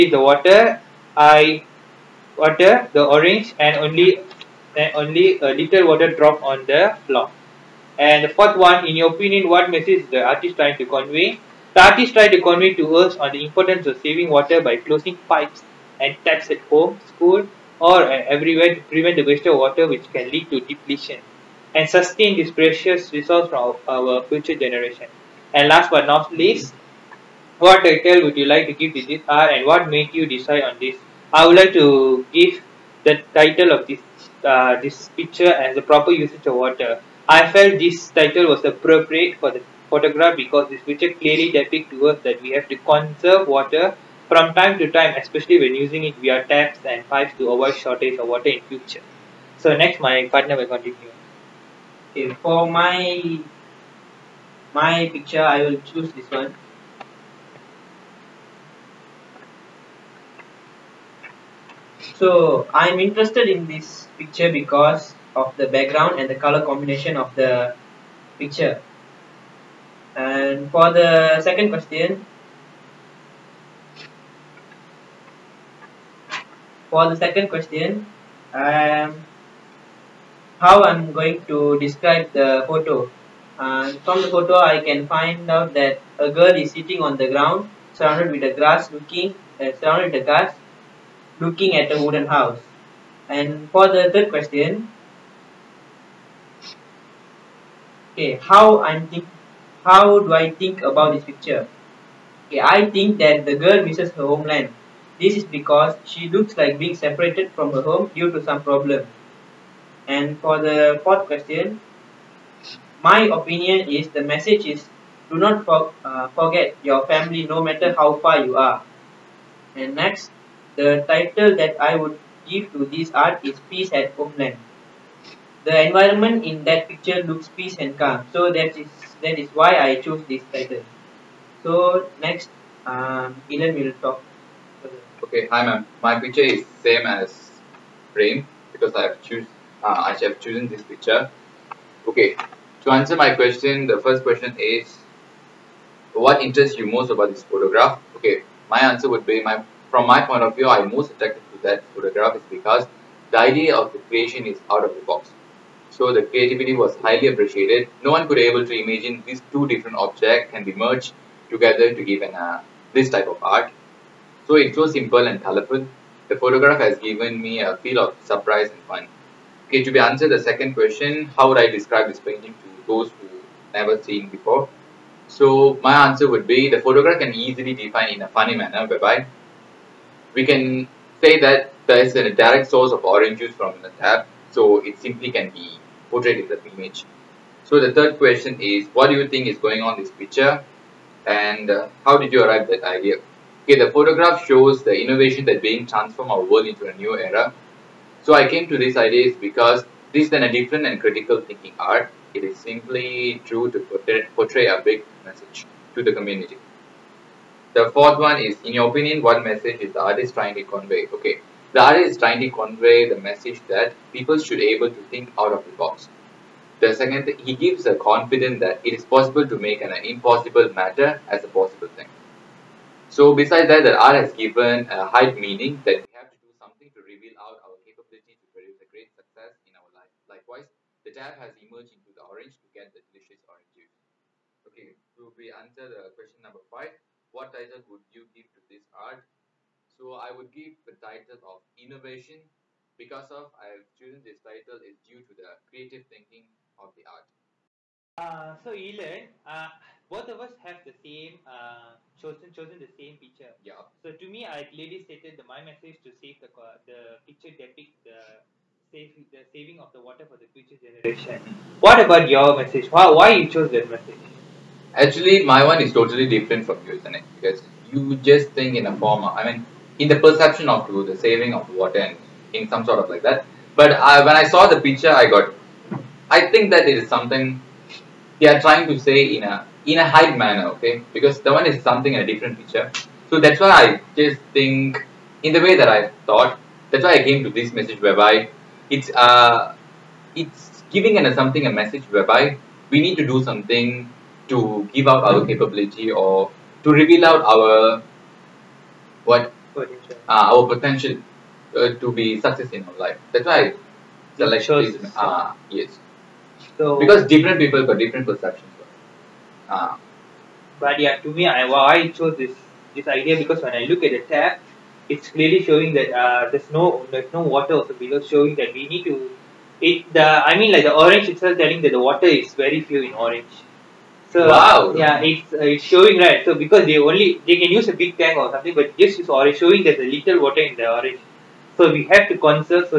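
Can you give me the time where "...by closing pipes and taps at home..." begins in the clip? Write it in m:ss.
0:14.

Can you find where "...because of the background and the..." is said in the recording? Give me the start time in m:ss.
1:04.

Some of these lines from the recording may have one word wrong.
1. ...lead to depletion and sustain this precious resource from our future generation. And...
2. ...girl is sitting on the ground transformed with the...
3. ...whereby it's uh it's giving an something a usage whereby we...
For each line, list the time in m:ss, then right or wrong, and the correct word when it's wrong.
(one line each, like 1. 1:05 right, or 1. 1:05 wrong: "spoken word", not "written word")
1. 0:20 right
2. 1:26 wrong: "surrounded", not "transformed"
3. 4:47 wrong: "message", not "usage".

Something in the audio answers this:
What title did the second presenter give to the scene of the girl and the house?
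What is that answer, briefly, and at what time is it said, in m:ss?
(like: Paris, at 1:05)
Peace at homeland, at 2:03.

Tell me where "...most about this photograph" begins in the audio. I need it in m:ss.
2:26.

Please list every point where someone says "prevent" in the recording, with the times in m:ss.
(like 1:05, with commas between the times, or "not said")
0:18.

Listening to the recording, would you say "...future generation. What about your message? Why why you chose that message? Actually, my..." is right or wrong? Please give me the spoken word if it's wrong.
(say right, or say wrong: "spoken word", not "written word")
right.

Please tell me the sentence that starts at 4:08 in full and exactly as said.
Uh, so Elon, uh, both of us have the same uh, chosen chosen the same picture.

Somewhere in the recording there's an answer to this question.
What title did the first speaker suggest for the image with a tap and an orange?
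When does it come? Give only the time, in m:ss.
0:35.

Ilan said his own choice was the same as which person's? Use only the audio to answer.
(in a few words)
Prem.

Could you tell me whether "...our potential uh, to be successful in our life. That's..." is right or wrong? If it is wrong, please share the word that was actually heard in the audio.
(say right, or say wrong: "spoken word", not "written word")
right.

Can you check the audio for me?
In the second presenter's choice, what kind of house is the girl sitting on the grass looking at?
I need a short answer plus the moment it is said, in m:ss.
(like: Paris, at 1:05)
A wooden house, at 1:32.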